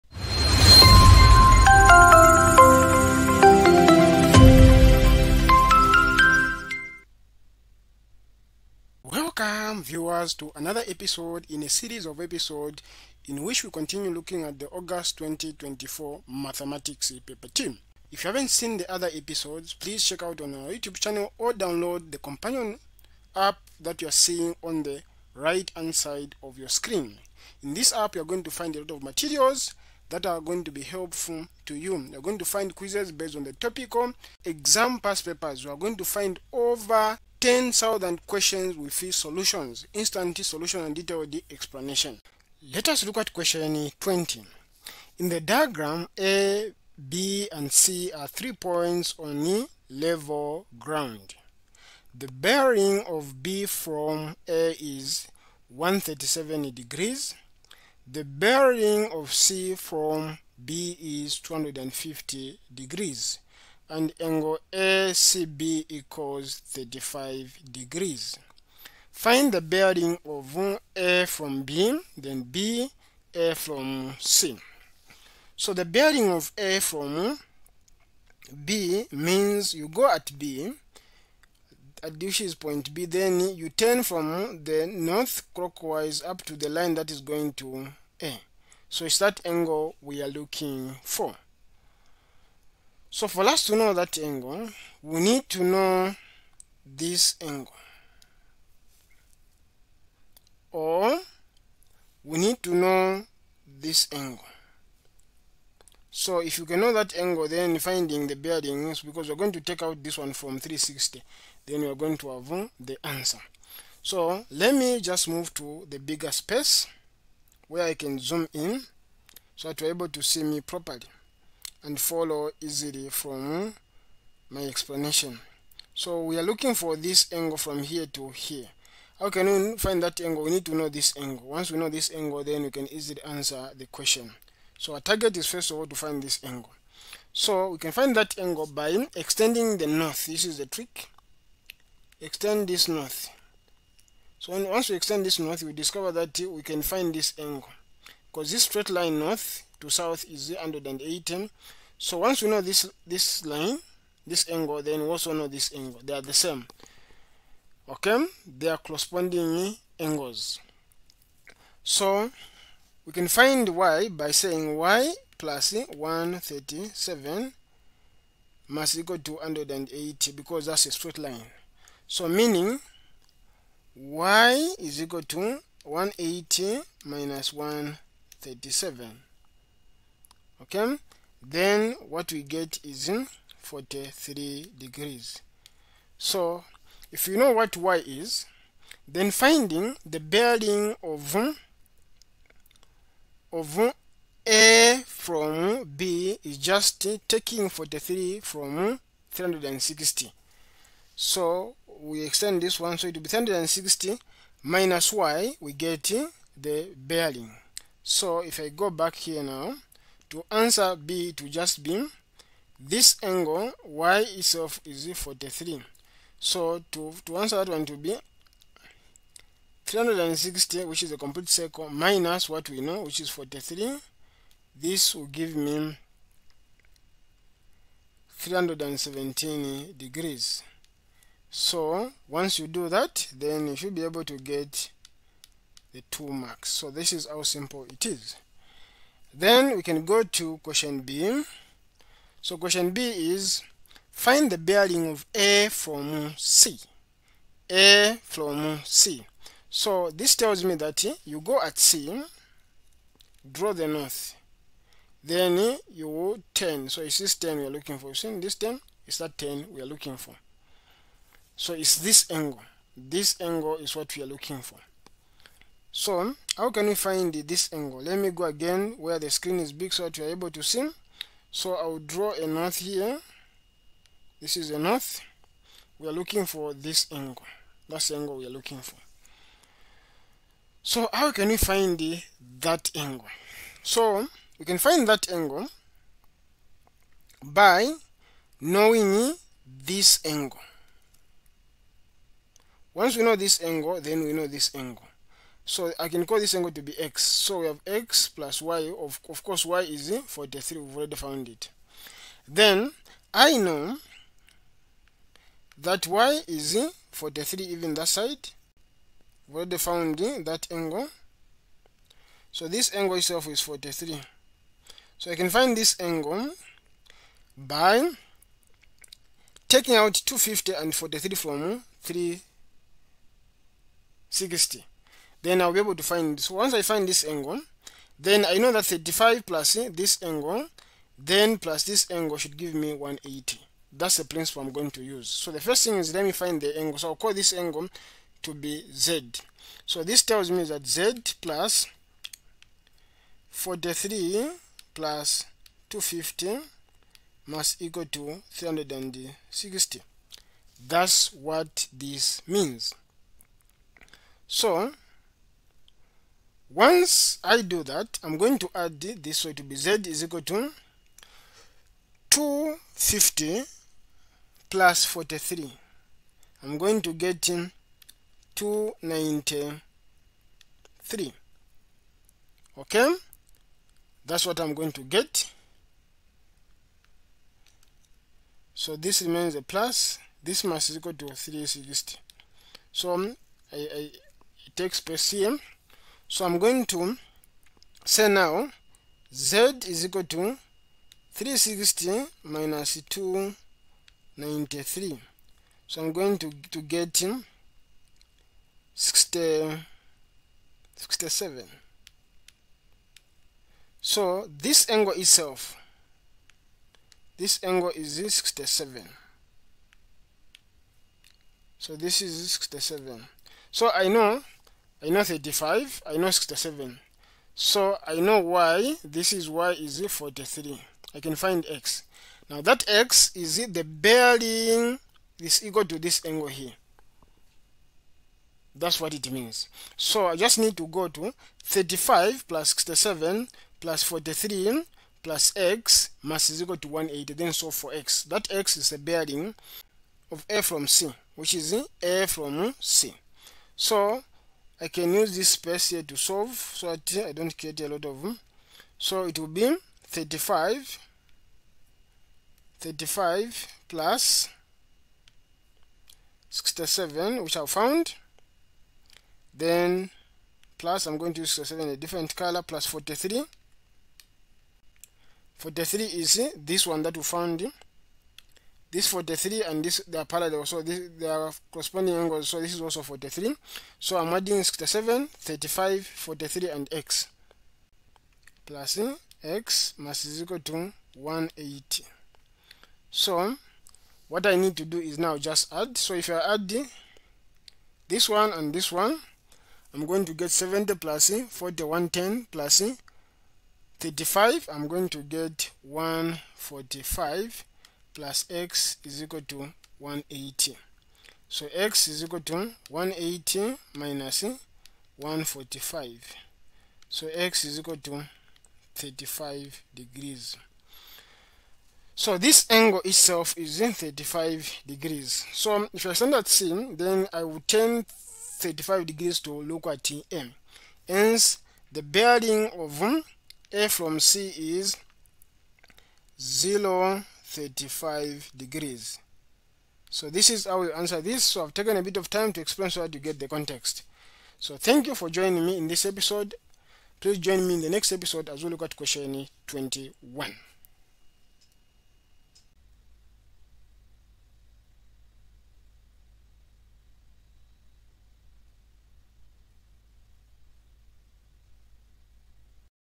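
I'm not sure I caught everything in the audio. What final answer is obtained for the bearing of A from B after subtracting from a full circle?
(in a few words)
317 degrees.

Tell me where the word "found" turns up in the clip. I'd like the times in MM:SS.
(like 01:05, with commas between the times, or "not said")
05:01, 05:09, 07:37, 07:47.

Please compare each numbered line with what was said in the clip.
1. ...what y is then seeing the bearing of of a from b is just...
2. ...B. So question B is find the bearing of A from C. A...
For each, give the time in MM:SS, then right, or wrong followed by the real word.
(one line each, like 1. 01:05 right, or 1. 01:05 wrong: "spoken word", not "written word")
1. 03:07 wrong: "finding", not "seeing"
2. 04:01 right.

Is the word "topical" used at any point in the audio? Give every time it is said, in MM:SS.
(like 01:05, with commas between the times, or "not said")
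00:33.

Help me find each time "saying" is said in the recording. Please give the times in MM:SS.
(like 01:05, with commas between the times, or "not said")
02:44.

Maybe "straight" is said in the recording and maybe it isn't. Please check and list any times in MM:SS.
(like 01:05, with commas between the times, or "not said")
02:28, 02:50.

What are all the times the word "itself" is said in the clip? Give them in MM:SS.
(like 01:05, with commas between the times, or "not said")
03:34, 05:13, 06:45, 08:33.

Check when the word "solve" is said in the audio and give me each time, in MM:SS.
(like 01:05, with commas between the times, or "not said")
07:17, 07:26.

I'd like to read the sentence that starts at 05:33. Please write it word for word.
That's the principle I'm going to use.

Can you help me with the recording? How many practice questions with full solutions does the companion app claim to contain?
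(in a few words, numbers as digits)
10,000.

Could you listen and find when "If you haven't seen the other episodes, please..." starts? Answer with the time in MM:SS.
00:18.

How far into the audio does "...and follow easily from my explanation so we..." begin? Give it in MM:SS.
02:01.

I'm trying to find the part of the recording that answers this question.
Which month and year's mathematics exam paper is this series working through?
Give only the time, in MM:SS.
00:14.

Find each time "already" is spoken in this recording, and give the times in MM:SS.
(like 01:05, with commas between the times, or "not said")
05:00, 05:09.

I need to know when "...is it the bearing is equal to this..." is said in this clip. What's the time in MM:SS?
07:03.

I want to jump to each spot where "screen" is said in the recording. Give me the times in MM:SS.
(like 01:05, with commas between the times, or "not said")
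00:26, 04:29.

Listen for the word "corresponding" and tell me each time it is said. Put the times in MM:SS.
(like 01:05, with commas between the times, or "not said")
02:38, 07:51.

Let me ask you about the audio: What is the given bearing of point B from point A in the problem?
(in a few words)
137 degrees.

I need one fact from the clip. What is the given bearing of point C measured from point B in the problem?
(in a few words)
250 degrees.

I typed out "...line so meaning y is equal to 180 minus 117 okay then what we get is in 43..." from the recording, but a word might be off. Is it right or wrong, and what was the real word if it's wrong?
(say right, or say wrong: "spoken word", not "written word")
wrong: "137", not "117".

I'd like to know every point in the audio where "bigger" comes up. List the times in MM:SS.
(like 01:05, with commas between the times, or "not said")
01:55.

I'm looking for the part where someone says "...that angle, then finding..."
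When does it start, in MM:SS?
01:46.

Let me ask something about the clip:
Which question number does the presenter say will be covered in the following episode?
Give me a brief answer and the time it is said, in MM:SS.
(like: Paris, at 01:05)
21, at 08:58.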